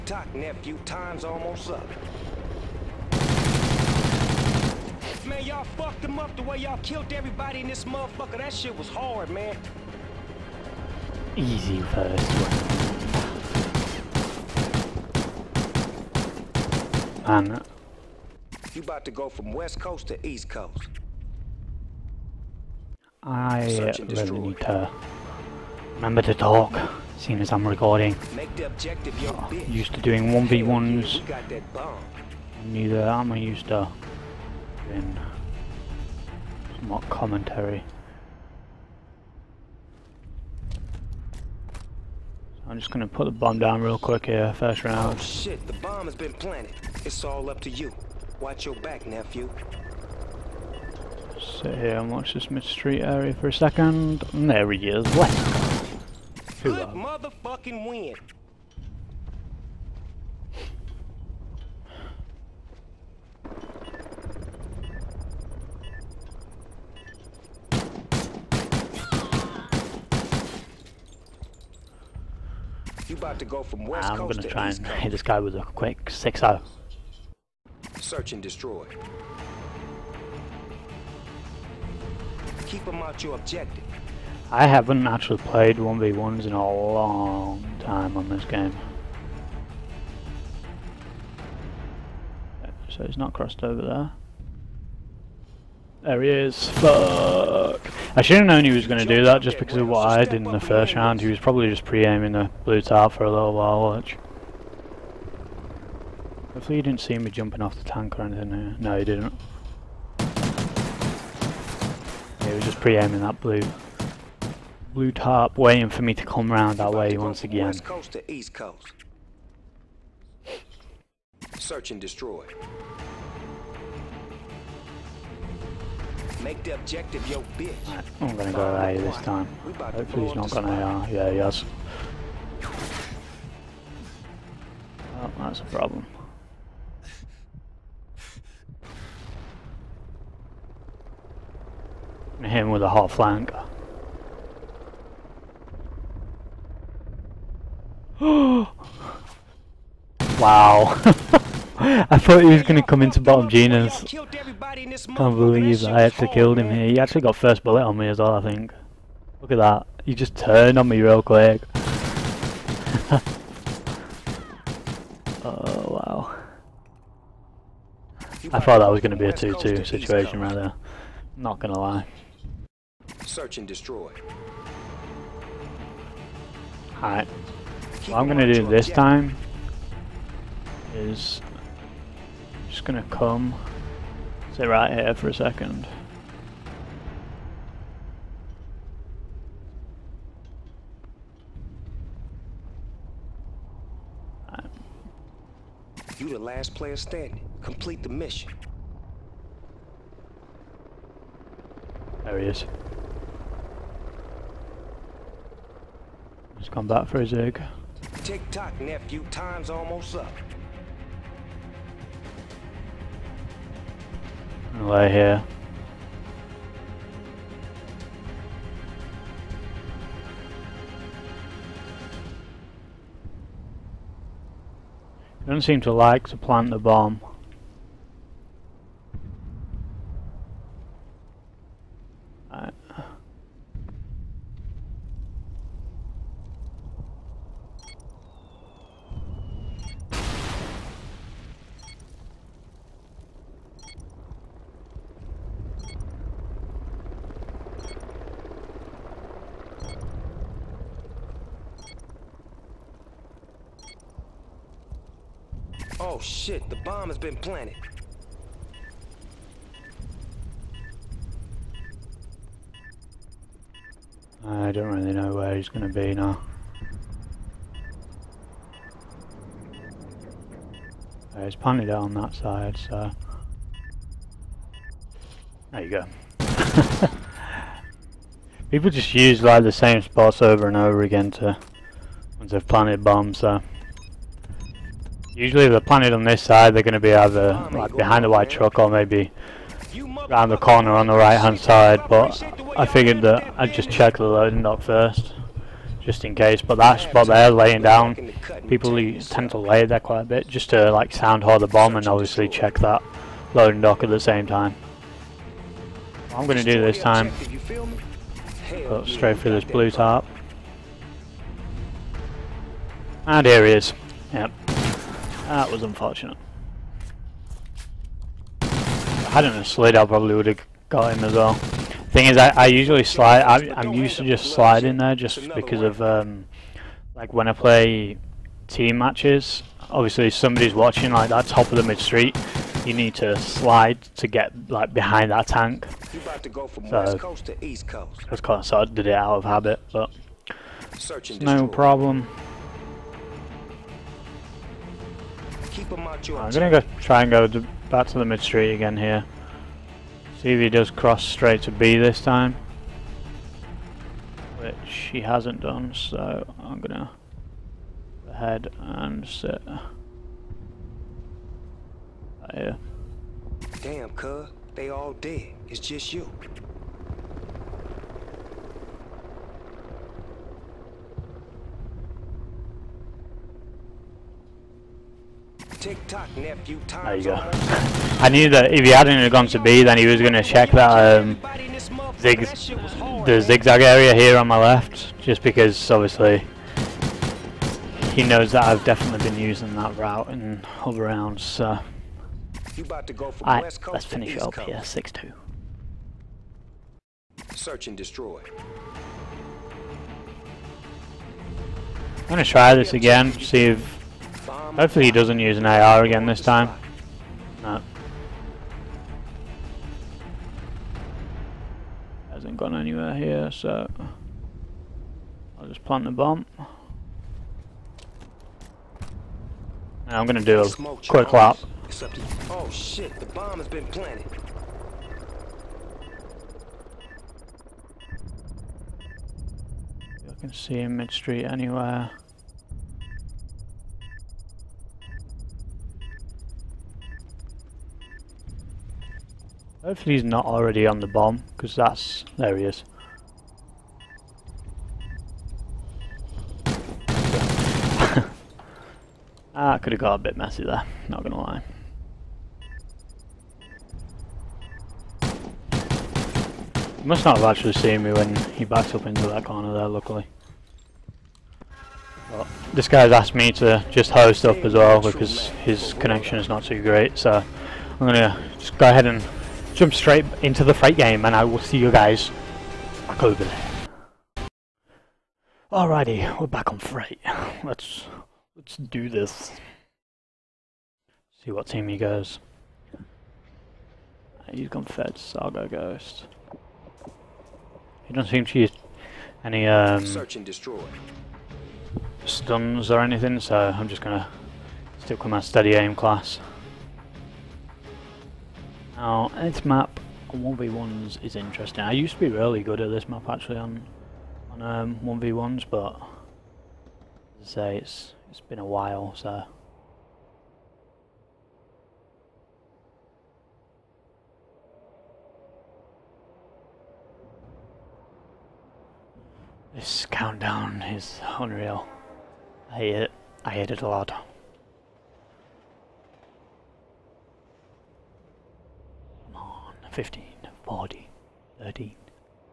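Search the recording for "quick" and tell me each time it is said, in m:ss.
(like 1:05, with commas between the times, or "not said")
0:43, 1:15, 2:41, 7:01.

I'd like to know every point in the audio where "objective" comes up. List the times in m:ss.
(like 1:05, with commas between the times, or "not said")
1:23, 2:06.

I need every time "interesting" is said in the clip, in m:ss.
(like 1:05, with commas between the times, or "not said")
8:21.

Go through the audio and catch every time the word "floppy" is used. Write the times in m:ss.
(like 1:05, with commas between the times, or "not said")
not said.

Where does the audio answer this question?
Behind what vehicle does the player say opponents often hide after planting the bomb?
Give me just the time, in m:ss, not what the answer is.
4:48.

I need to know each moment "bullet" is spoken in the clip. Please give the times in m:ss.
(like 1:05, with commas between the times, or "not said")
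2:37.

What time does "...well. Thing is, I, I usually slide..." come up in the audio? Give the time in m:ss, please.
5:21.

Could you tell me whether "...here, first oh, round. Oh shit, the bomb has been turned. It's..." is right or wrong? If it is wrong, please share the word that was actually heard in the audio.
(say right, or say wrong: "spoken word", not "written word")
wrong: "planted", not "turned".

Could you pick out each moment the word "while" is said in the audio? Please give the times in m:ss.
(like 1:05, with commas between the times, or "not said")
1:43, 8:28.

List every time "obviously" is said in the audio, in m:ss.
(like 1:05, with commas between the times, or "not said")
5:02, 5:29, 6:25.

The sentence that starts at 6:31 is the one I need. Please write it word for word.
So, let's finish it up here, six two.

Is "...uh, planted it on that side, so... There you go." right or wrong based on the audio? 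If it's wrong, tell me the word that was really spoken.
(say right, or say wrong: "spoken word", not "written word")
right.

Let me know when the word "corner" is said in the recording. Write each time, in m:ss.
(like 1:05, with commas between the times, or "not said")
4:50, 7:39.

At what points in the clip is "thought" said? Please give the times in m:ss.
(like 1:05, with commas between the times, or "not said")
2:32, 2:48.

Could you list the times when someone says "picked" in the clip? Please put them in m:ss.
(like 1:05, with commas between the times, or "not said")
not said.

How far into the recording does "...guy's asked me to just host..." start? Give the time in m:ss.
7:42.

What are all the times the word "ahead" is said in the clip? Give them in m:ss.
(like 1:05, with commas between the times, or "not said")
5:58, 7:48.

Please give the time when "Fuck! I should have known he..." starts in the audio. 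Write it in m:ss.
1:36.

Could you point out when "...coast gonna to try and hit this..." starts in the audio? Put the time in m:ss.
1:14.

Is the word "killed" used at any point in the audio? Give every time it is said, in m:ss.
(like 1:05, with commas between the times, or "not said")
0:06, 2:36.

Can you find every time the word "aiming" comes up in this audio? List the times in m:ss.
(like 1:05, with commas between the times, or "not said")
1:41, 1:52.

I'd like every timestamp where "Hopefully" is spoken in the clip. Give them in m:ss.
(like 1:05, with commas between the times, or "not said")
1:46, 2:09, 6:44, 7:19.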